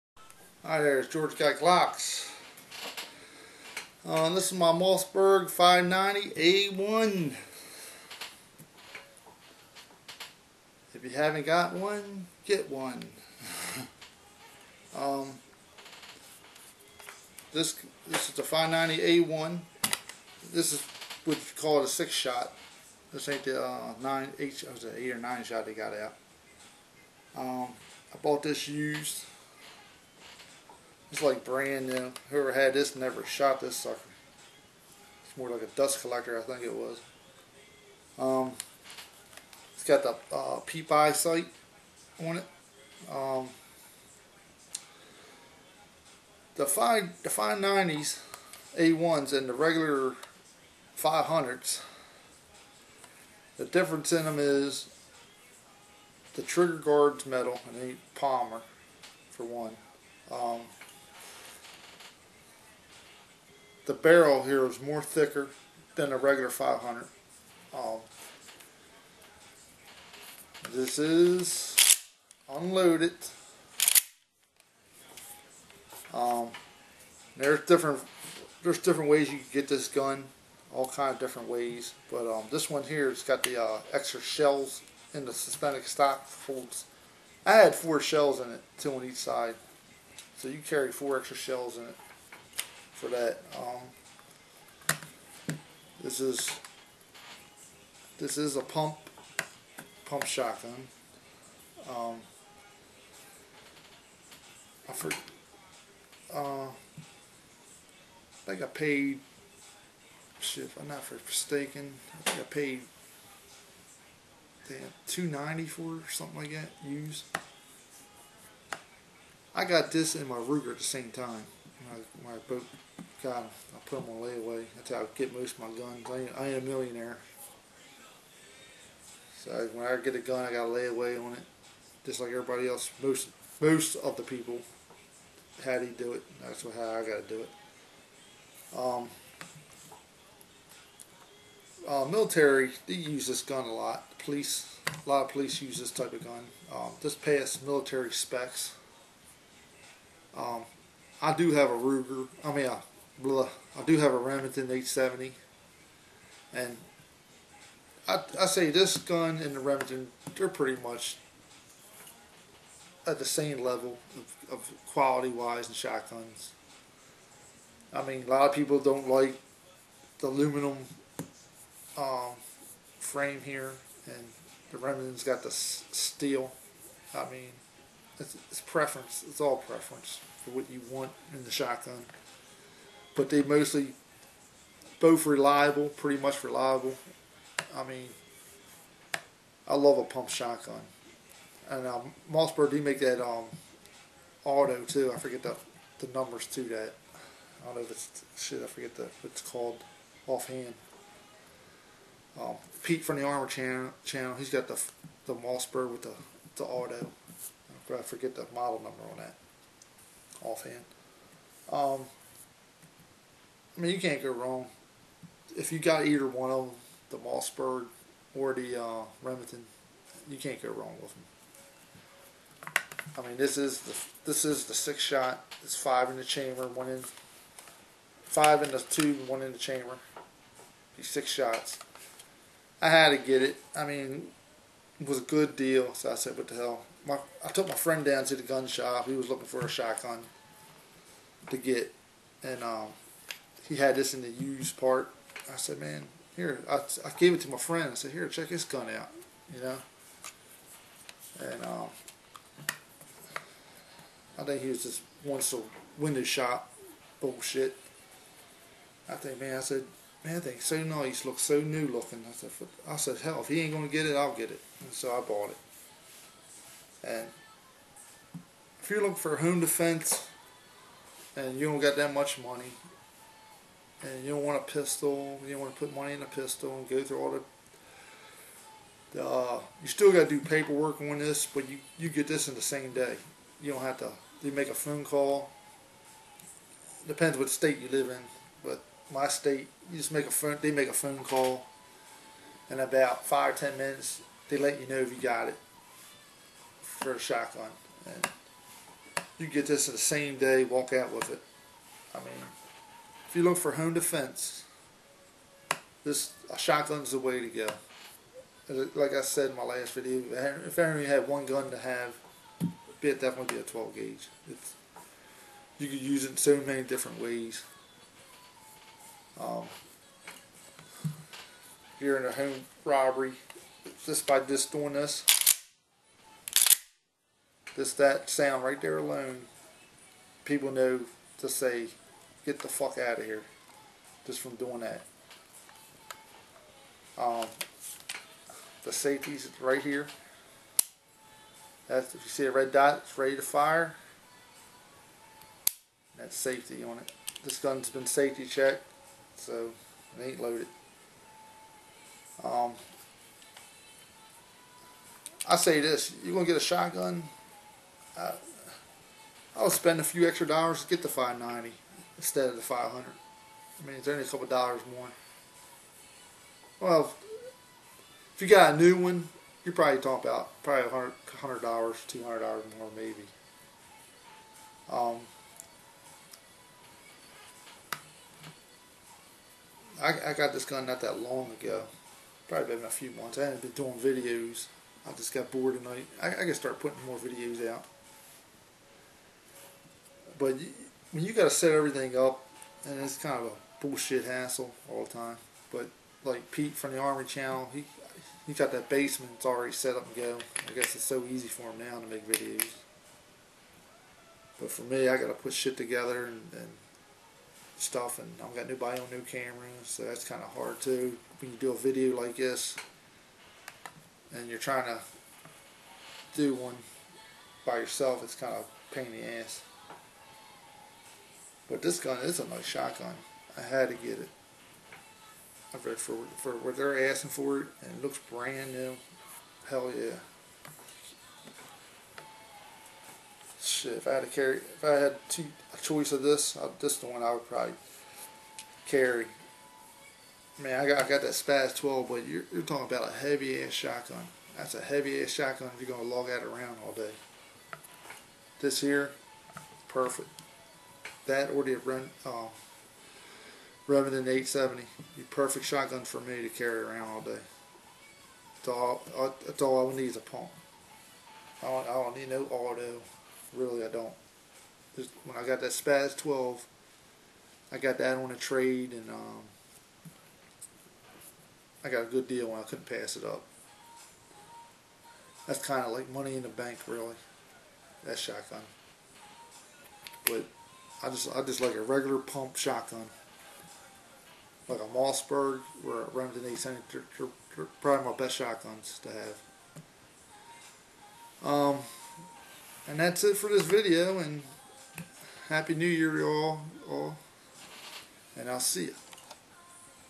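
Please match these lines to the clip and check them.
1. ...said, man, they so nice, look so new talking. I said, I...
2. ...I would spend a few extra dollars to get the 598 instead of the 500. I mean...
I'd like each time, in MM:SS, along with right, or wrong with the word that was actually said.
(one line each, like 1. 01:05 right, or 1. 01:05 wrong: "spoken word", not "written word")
1. 04:19 wrong: "looking", not "talking"
2. 05:59 wrong: "590", not "598".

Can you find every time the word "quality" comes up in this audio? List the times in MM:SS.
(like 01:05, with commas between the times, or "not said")
02:44.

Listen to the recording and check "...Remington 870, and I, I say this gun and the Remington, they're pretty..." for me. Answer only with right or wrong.
right.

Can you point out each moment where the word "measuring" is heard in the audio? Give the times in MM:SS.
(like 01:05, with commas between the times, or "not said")
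not said.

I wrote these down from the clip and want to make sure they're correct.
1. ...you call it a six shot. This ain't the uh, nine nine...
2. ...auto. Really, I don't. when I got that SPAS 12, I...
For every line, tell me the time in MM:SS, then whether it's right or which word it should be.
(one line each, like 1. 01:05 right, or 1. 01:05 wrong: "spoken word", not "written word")
1. 00:21 wrong: "eight", not "nine"
2. 07:42 right.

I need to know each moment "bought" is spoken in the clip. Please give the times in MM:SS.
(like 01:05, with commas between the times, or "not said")
00:28, 04:25.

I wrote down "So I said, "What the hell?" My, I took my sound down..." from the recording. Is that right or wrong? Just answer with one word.
wrong.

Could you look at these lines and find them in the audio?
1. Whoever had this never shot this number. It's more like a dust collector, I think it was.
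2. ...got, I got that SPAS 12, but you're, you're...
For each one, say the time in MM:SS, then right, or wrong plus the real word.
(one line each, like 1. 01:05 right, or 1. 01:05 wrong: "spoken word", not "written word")
1. 00:32 wrong: "sucker", not "number"
2. 07:20 right.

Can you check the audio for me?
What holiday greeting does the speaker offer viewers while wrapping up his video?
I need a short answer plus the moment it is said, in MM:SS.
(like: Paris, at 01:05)
Happy New Year, at 08:15.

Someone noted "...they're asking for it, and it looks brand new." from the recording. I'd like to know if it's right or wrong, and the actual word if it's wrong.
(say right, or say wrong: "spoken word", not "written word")
right.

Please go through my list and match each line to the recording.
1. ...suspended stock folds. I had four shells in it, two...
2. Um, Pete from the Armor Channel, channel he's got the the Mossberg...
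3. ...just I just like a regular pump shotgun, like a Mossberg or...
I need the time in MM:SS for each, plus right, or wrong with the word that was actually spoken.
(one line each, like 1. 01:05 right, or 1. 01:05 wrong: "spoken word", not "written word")
1. 01:25 right
2. 03:22 right
3. 08:01 right.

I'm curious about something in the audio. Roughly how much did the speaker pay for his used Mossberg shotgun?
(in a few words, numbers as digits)
$290.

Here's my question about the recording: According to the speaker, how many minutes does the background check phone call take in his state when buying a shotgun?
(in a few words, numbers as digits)
5 or 10 minutes.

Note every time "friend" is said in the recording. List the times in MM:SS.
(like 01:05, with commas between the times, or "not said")
03:57, 04:07.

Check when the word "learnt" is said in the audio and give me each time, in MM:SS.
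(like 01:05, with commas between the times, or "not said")
not said.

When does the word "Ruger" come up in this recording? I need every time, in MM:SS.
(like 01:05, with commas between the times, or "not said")
02:00, 02:31.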